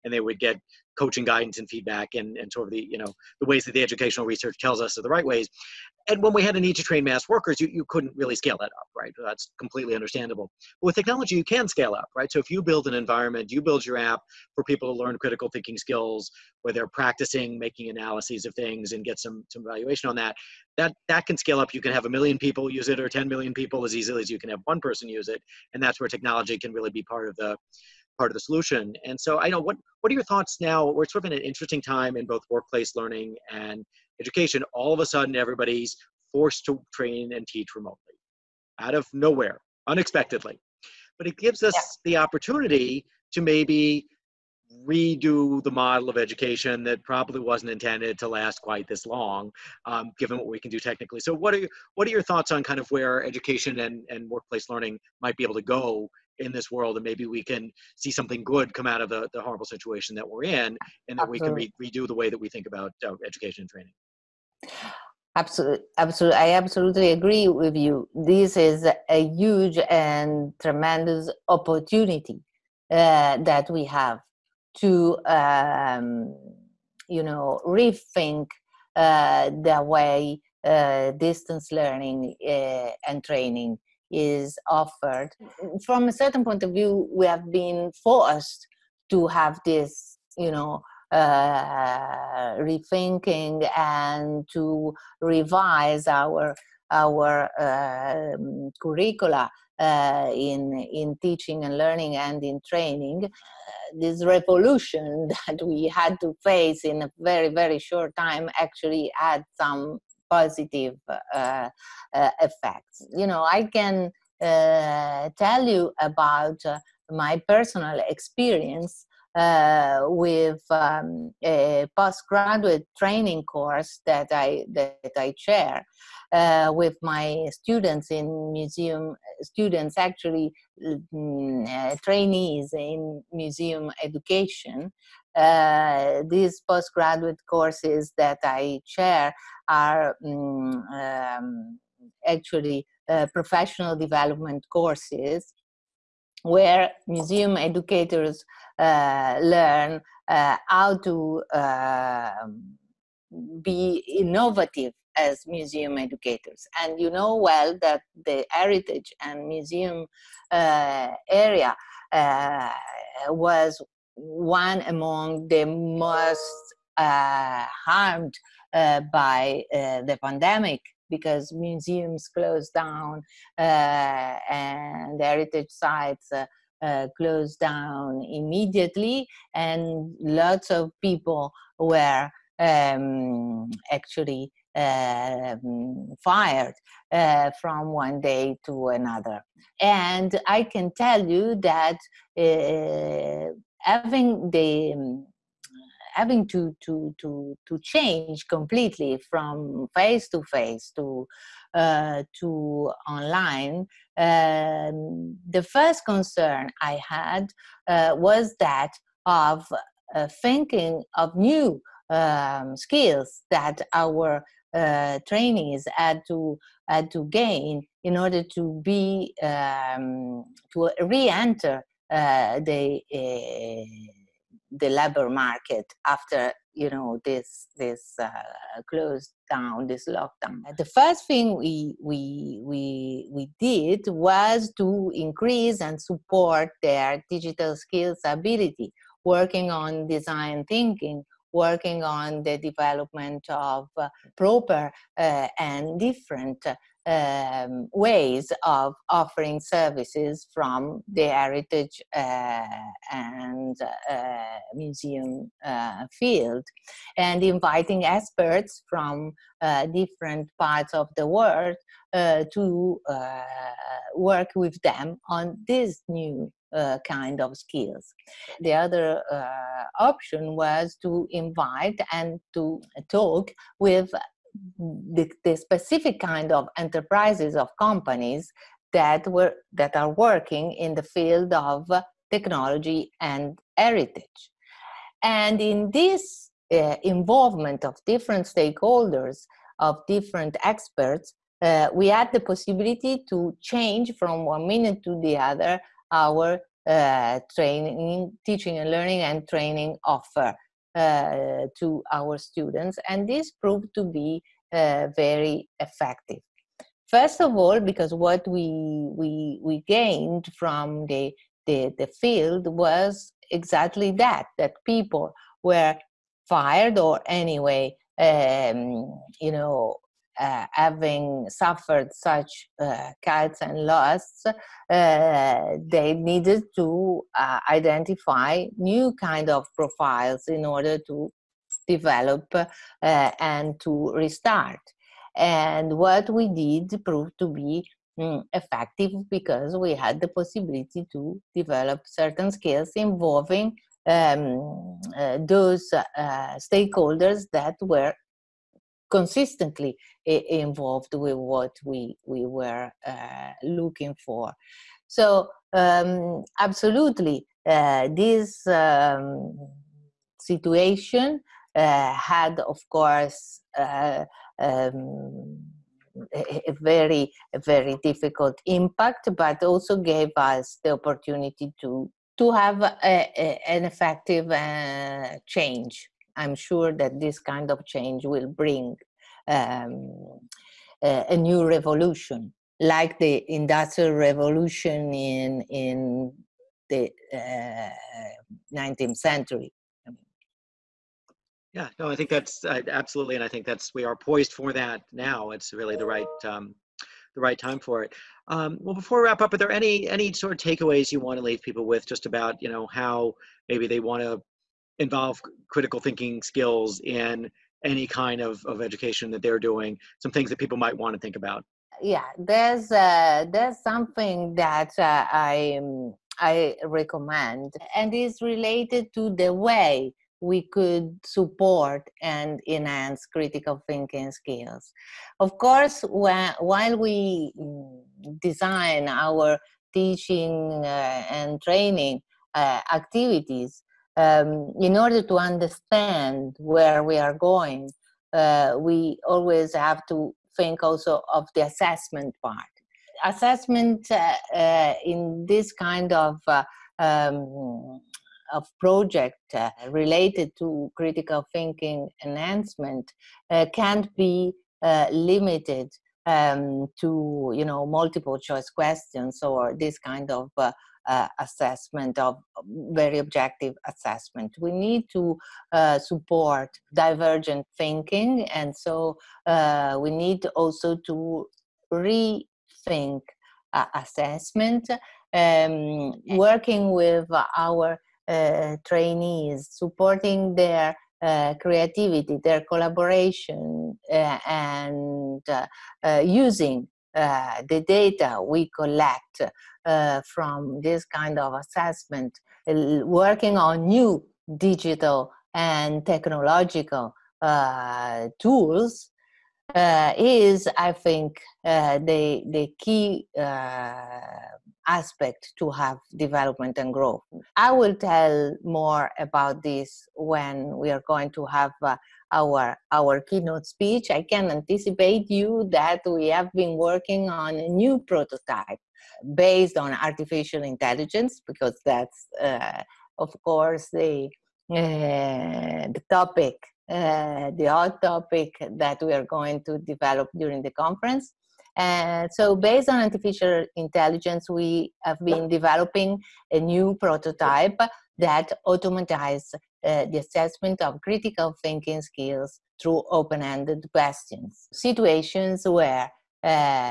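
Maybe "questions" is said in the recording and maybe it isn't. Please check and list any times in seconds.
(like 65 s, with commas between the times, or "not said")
458 s, 543 s.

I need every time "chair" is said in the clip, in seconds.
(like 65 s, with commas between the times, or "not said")
125 s, 138 s.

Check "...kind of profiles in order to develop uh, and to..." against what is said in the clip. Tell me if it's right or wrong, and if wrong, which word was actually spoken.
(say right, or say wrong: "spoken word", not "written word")
right.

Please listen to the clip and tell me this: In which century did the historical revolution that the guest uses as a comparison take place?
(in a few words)
19th century.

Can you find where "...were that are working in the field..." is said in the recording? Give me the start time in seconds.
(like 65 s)
279 s.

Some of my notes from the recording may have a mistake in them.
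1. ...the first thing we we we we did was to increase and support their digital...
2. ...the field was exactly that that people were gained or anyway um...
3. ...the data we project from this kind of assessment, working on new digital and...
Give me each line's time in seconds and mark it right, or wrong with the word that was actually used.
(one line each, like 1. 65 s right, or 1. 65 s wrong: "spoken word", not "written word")
1. 230 s right
2. 311 s wrong: "fired", not "gained"
3. 487 s wrong: "collect", not "project".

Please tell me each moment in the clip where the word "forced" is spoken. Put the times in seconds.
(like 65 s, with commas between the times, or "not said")
36 s, 88 s.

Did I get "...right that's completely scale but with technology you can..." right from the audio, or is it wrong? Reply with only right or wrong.
wrong.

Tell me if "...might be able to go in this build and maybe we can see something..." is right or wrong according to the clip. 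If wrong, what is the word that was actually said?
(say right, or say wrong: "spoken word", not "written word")
wrong: "world", not "build".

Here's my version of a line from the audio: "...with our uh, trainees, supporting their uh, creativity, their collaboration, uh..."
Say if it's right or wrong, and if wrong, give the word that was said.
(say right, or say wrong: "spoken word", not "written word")
right.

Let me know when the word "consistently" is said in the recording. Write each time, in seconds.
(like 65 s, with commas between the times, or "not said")
349 s.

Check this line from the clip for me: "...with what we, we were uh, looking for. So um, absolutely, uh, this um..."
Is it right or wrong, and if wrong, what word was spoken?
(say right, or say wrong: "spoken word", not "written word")
right.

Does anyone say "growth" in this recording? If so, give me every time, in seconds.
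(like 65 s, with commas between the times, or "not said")
506 s.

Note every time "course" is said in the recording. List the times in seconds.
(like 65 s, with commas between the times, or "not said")
123 s, 137 s, 144 s, 362 s, 425 s, 523 s.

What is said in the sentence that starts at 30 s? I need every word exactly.
We're sort of in an interesting time in both workplace learning and education.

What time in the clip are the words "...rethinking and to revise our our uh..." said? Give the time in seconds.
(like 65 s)
92 s.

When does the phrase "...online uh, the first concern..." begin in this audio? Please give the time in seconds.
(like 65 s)
203 s.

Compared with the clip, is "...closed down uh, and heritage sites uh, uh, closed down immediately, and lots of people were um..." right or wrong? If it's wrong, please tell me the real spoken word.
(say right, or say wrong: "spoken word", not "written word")
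right.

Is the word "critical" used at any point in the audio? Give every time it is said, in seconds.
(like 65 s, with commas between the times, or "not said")
15 s, 405 s, 423 s, 450 s, 541 s.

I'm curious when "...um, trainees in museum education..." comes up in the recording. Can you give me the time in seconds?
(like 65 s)
131 s.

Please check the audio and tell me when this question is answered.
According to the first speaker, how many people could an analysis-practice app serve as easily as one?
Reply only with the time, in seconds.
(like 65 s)
23 s.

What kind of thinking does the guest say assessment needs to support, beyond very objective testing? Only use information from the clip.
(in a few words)
divergent thinking.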